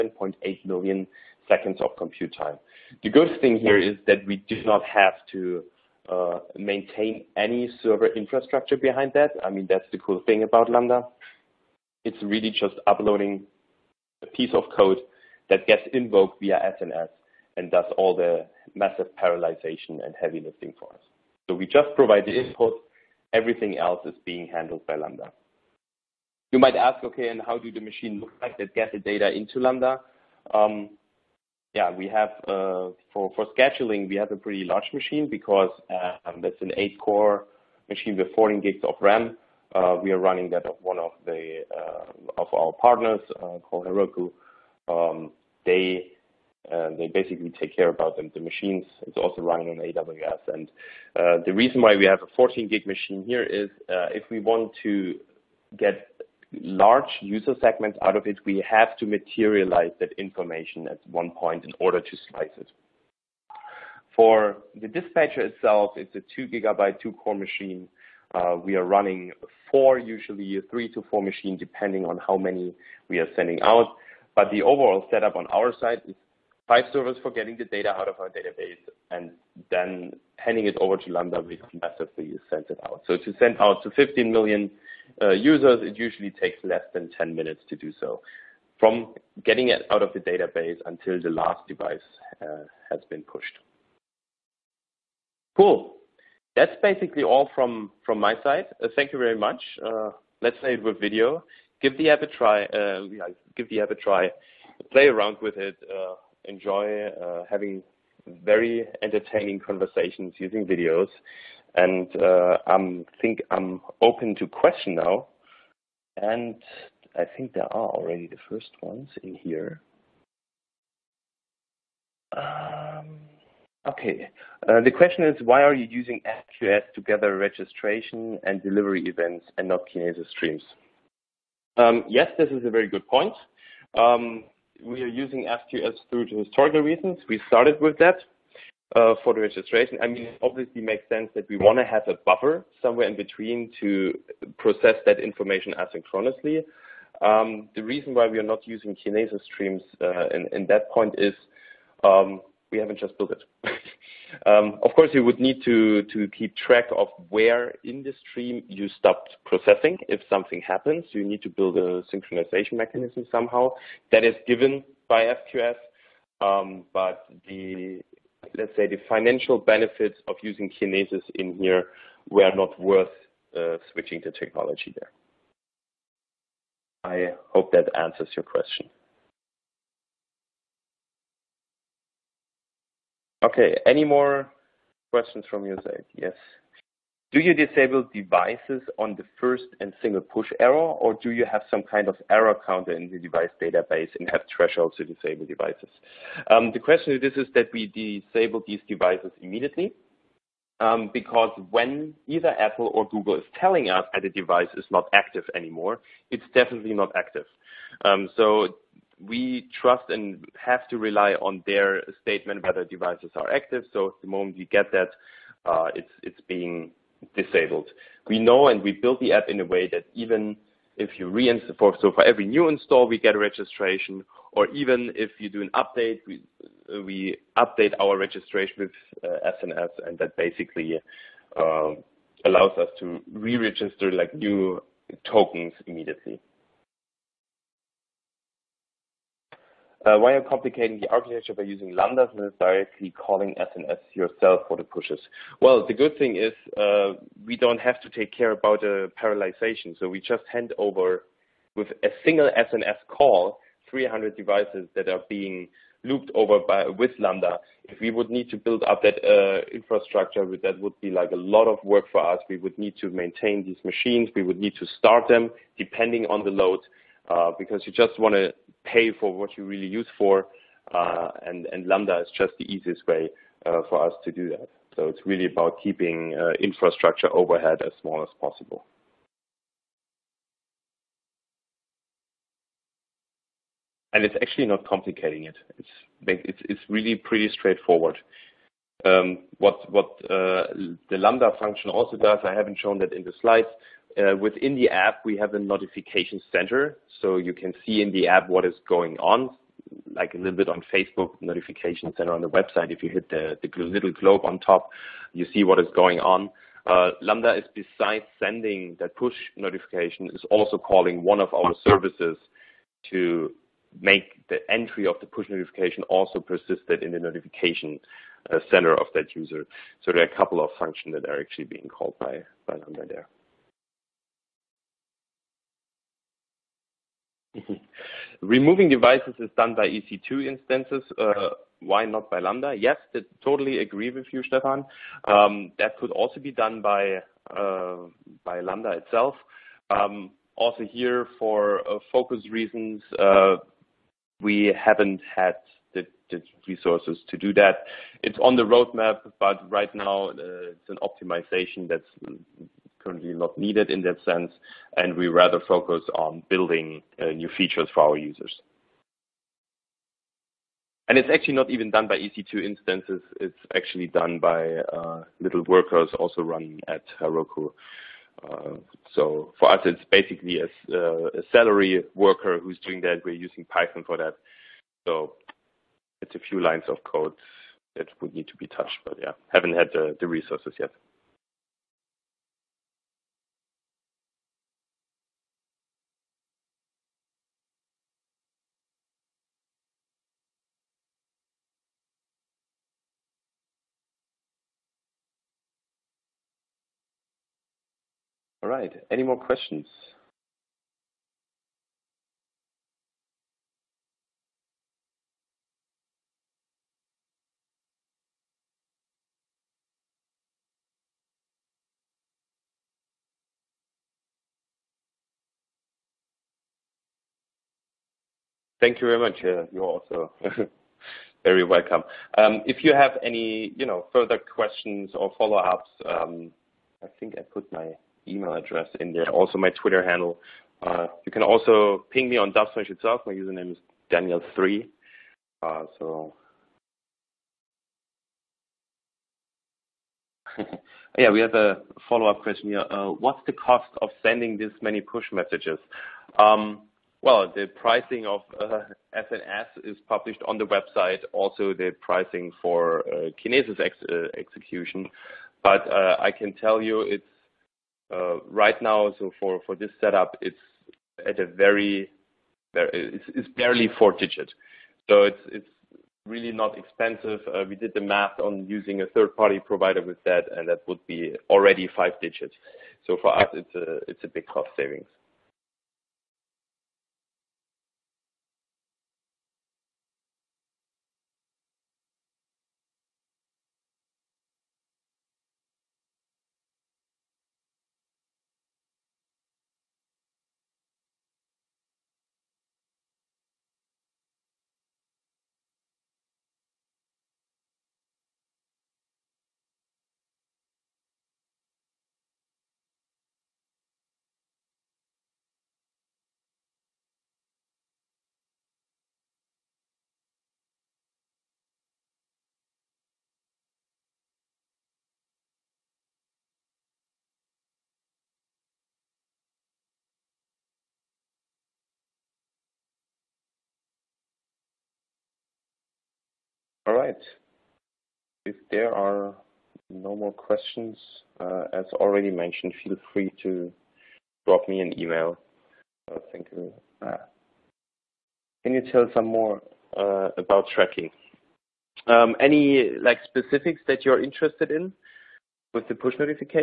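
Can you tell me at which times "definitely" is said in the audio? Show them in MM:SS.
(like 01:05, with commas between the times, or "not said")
03:26.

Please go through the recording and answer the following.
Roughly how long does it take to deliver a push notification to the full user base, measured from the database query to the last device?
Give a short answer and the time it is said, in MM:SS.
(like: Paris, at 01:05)
less than 10 minutes, at 01:26.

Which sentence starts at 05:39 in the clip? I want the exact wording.
Um, also here, for uh, focus reasons, uh, we haven't had the, the, resources to do that.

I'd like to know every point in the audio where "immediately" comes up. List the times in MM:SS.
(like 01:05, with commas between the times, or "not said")
03:19, 03:55.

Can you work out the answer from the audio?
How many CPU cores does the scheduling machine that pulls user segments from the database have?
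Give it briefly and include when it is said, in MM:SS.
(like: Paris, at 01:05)
8, at 00:36.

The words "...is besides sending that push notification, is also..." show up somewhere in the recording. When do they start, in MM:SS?
05:07.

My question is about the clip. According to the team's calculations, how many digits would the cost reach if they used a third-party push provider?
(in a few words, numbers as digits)
five digits.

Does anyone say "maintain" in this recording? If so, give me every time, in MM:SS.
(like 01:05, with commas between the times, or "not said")
00:06, 04:23.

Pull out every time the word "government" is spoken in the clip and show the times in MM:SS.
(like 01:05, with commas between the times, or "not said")
not said.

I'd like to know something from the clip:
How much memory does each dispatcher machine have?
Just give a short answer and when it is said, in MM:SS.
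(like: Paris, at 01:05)
2 gigabytes, at 01:06.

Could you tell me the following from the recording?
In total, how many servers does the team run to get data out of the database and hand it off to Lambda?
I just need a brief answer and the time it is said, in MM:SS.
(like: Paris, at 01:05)
5, at 01:16.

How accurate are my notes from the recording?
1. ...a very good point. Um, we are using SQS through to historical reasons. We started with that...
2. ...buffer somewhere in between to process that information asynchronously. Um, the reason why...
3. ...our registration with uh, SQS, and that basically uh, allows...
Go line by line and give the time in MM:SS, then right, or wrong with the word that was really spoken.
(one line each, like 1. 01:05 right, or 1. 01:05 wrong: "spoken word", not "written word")
1. 02:12 right
2. 02:22 right
3. 03:47 wrong: "SNS", not "SQS".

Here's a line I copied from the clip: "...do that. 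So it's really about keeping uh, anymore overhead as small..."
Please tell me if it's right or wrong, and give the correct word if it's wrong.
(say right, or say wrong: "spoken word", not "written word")
wrong: "infrastructure", not "anymore".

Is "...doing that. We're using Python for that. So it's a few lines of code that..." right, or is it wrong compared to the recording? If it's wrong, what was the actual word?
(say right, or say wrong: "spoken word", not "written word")
right.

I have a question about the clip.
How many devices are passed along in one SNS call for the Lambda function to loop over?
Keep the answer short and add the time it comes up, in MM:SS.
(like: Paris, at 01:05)
300, at 04:13.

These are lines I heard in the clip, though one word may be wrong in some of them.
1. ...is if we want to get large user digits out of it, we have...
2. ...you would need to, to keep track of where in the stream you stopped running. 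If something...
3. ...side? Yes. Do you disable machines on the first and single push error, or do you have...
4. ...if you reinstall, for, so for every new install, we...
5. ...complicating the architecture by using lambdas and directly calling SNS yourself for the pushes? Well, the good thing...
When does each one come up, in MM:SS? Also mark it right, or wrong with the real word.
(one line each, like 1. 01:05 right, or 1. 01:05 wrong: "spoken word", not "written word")
1. 00:53 wrong: "segments", not "digits"
2. 02:35 wrong: "processing", not "running"
3. 03:05 wrong: "devices", not "machines"
4. 03:40 right
5. 04:00 right.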